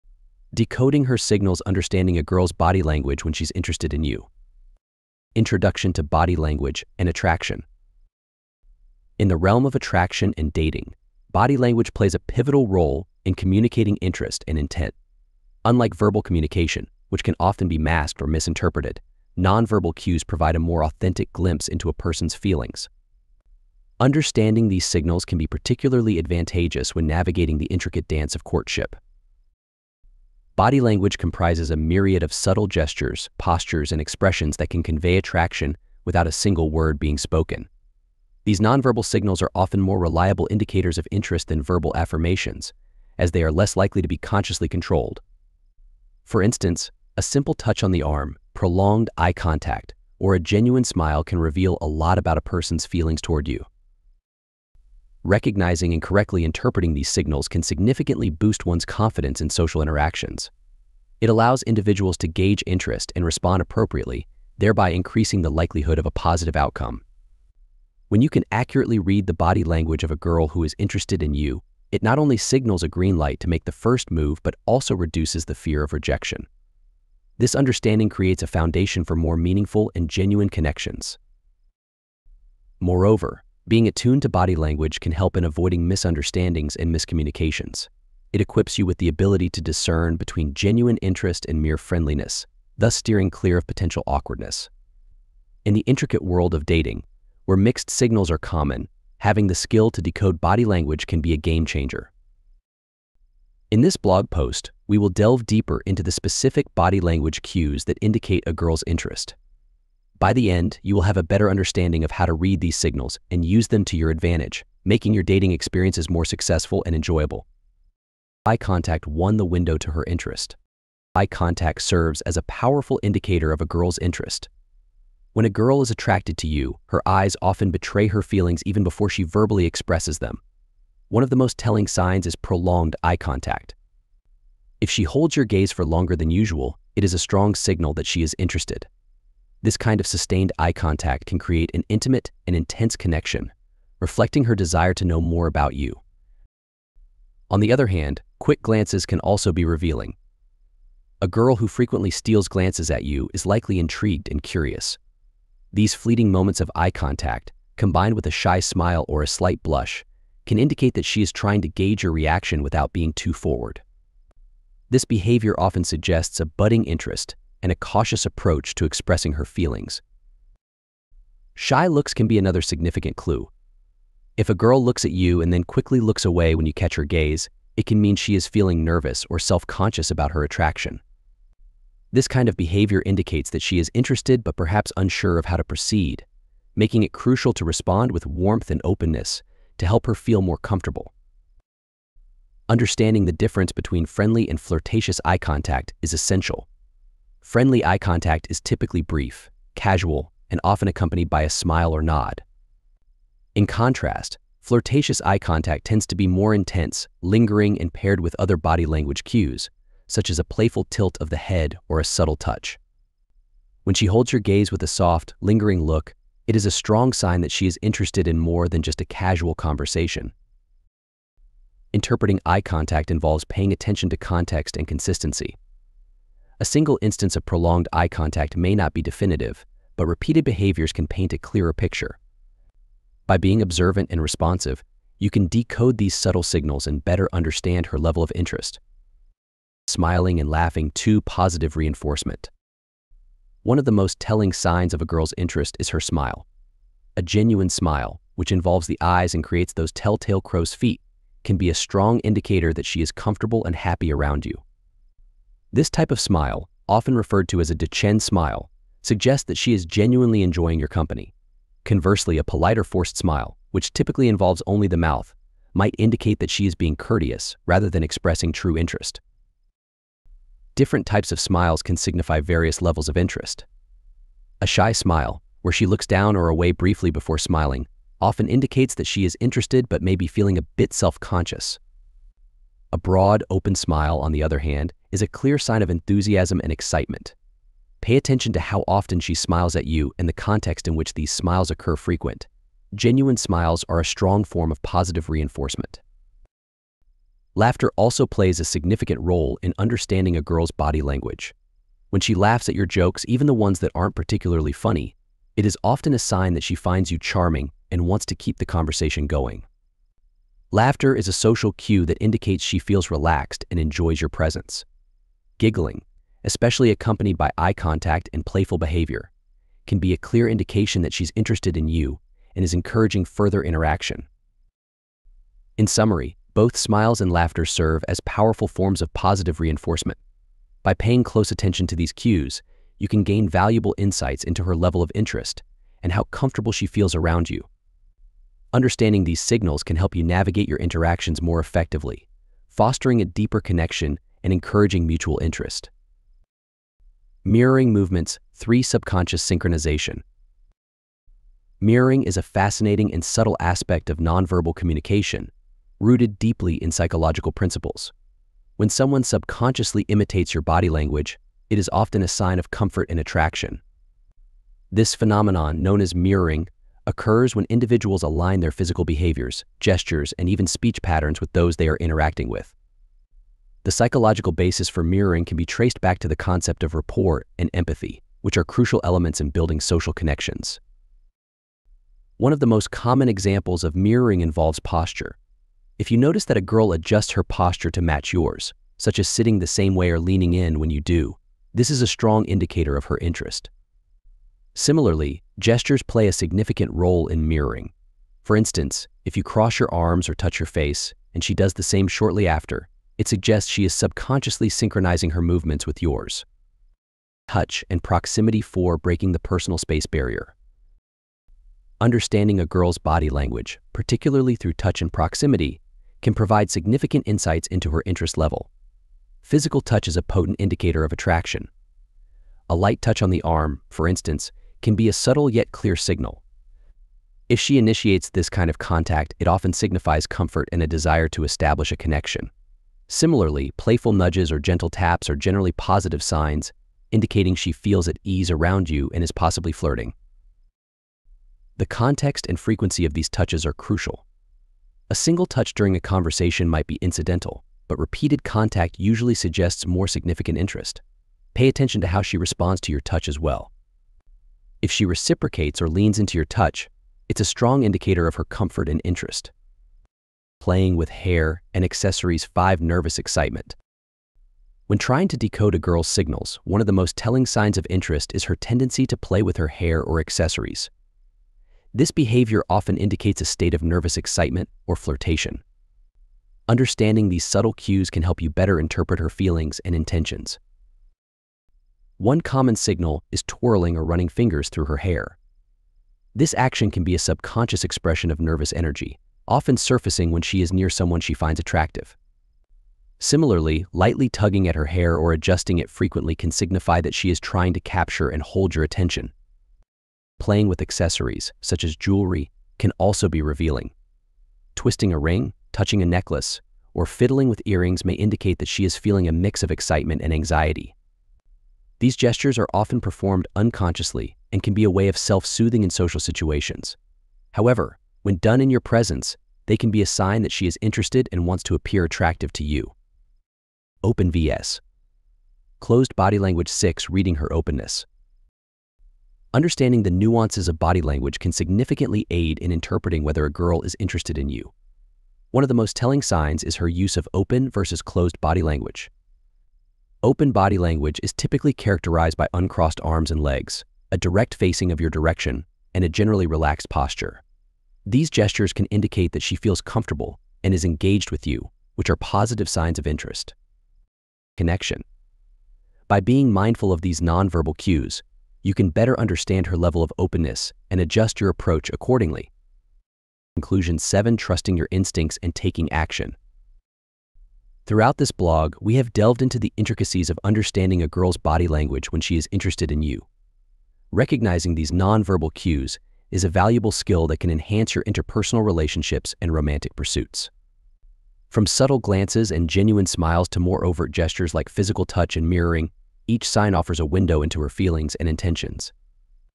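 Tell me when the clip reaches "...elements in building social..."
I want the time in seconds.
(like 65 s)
379 s.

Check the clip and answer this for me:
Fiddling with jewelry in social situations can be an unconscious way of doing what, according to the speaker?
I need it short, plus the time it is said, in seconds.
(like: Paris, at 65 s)
self-soothing, at 515 s.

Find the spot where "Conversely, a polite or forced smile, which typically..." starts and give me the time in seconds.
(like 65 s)
261 s.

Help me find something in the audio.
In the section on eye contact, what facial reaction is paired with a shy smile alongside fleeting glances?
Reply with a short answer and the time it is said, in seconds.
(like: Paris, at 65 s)
a slight blush, at 159 s.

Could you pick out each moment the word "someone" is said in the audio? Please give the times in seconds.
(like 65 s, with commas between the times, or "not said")
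358 s, 490 s.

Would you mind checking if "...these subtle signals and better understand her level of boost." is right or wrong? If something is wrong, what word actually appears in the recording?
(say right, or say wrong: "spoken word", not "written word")
wrong: "interest", not "boost".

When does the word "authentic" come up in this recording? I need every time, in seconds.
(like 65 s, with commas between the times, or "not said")
20 s.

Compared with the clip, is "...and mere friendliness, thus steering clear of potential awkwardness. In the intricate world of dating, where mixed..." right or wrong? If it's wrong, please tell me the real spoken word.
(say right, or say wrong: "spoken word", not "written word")
right.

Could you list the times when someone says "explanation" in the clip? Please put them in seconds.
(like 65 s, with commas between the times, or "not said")
not said.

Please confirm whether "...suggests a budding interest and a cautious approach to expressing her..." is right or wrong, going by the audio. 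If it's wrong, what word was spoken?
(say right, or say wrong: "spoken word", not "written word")
right.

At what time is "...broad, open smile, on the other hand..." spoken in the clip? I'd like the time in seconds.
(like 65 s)
282 s.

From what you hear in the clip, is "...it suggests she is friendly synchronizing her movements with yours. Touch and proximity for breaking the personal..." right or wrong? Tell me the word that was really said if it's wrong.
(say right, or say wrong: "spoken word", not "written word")
wrong: "subconsciously", not "friendly".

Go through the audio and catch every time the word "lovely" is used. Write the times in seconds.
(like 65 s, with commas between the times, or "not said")
not said.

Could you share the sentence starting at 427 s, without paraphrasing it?
If she initiates this kind of contact, it often signifies comfort and a desire to establish a connection.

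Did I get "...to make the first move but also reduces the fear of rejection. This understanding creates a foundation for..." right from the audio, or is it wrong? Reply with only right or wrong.
right.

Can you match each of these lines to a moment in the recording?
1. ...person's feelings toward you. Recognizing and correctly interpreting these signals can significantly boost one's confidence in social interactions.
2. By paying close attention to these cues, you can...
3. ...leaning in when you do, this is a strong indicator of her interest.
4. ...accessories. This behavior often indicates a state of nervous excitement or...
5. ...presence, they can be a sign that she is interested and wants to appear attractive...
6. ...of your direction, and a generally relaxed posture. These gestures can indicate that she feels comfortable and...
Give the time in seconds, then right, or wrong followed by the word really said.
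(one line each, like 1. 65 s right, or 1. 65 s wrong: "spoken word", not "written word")
1. 52 s right
2. 330 s right
3. 390 s right
4. 470 s right
5. 518 s right
6. 544 s right.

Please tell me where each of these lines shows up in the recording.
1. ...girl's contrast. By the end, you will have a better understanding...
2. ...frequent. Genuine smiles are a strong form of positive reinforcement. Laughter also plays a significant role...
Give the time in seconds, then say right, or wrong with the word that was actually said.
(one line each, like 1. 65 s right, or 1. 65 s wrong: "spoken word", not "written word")
1. 108 s wrong: "interest", not "contrast"
2. 291 s right.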